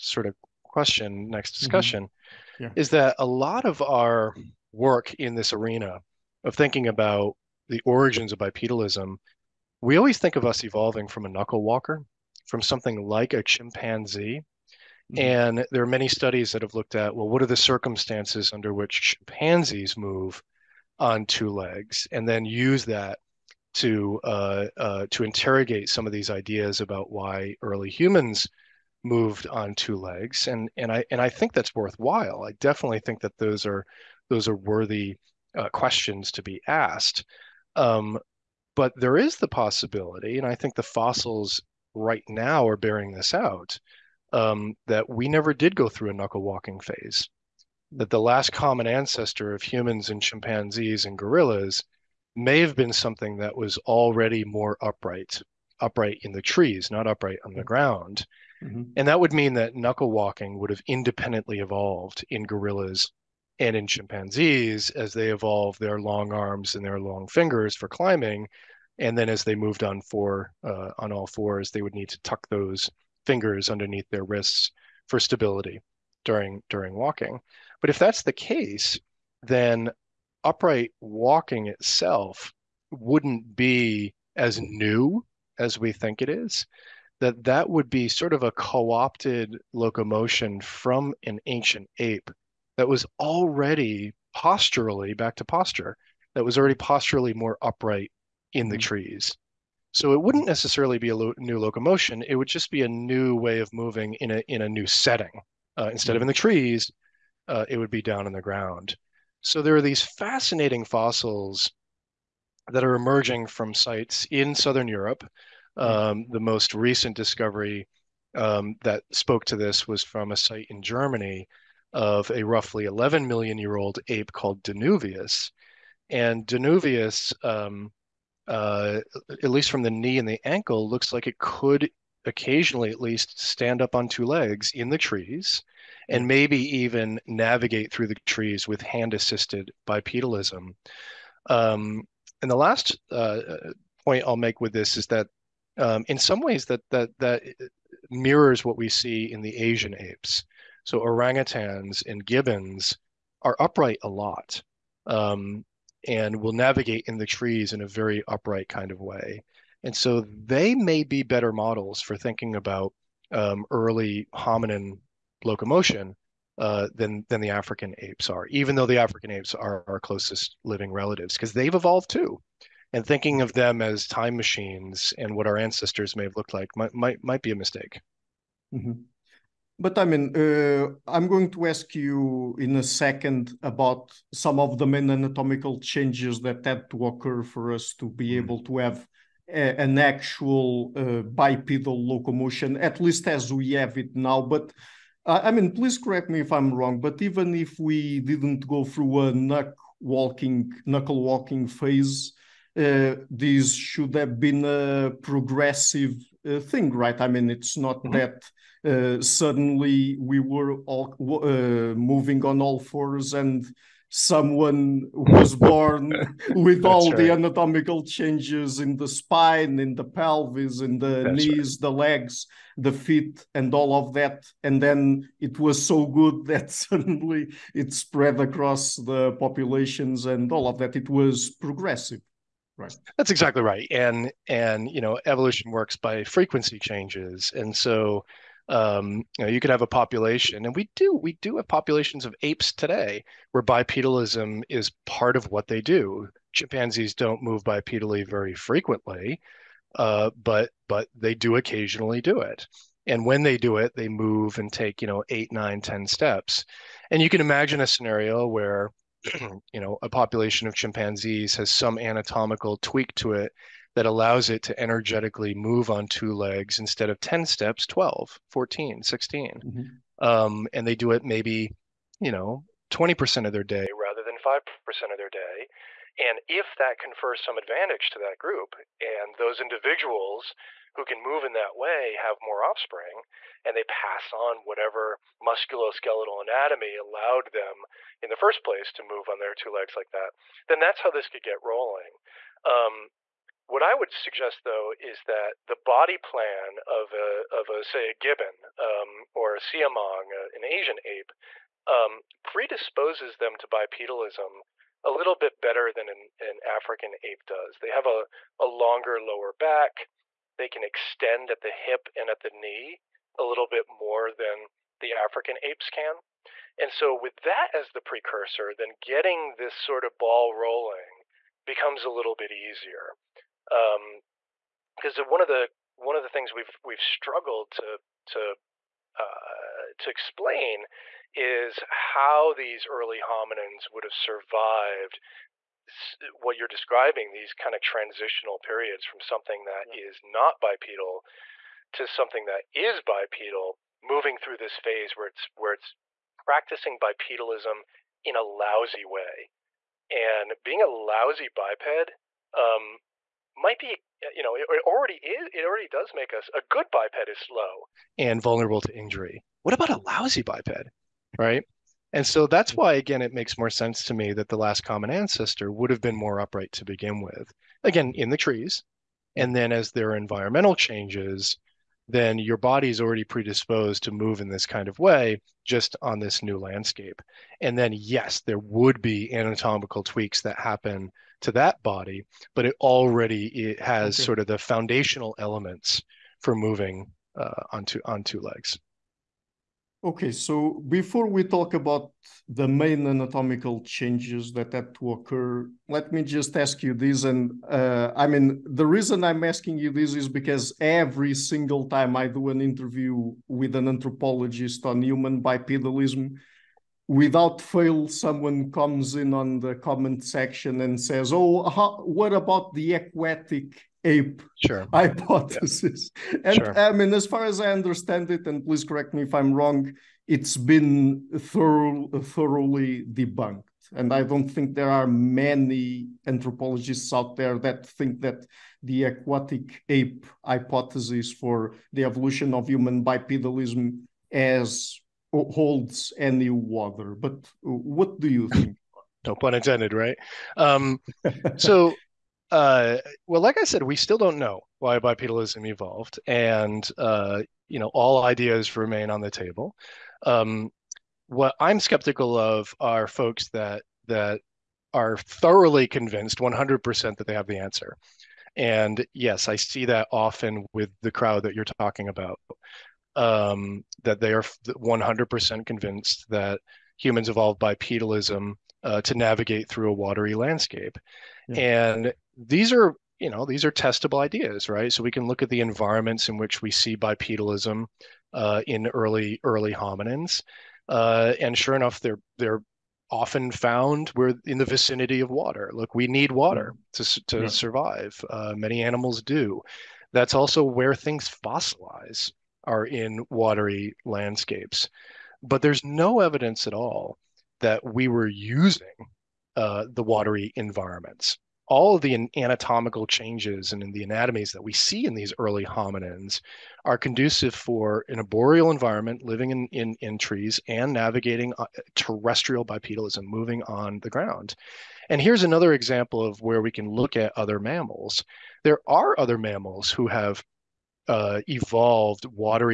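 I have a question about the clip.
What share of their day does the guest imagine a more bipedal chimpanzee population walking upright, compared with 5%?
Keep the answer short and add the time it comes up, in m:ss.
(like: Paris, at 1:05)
20%, at 4:32.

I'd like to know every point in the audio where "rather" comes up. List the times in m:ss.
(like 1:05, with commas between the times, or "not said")
4:33.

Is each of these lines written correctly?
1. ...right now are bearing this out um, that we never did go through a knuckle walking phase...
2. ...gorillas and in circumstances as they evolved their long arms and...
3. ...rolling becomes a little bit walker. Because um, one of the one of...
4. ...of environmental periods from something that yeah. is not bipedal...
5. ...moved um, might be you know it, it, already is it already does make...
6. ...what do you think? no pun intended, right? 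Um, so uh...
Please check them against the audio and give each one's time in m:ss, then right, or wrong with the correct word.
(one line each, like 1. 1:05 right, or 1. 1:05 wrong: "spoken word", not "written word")
1. 0:41 right
2. 1:02 wrong: "chimpanzees", not "circumstances"
3. 5:20 wrong: "easier", not "walker"
4. 5:37 wrong: "transitional", not "environmental"
5. 5:51 wrong: "biped", not "moved"
6. 7:17 right.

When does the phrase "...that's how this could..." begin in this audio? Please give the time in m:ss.
4:50.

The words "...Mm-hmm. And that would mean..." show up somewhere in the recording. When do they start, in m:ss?
0:58.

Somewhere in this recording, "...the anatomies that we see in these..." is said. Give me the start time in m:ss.
8:23.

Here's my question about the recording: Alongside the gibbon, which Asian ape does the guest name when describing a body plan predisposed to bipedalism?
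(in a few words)
Siamang.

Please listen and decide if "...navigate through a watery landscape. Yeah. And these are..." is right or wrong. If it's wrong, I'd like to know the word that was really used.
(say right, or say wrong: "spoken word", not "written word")
right.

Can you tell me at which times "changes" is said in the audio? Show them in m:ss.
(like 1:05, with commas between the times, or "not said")
3:05, 3:38, 3:56, 6:10, 6:33, 8:23.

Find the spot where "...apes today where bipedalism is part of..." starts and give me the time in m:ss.
4:02.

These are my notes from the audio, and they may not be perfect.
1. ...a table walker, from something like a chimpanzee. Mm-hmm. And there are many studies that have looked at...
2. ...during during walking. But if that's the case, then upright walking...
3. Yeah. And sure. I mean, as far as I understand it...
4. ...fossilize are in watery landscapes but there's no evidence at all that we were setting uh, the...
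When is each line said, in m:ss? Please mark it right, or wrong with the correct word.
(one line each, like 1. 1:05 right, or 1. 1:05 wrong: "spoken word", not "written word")
1. 0:11 wrong: "knuckle", not "table"
2. 1:16 right
3. 6:56 right
4. 8:11 wrong: "using", not "setting".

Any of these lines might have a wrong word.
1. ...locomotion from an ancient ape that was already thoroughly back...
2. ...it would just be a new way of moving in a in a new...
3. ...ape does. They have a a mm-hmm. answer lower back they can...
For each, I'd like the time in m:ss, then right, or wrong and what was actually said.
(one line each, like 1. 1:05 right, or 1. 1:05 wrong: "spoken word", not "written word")
1. 1:29 wrong: "posturally", not "thoroughly"
2. 1:42 right
3. 5:07 wrong: "longer", not "answer".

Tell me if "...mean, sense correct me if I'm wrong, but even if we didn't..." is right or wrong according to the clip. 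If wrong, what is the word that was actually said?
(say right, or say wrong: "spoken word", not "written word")
wrong: "please", not "sense".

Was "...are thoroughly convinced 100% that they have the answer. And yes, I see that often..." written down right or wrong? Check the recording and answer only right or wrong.
right.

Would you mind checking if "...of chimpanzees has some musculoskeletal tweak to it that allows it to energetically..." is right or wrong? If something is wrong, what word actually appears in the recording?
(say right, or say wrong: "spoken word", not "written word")
wrong: "anatomical", not "musculoskeletal".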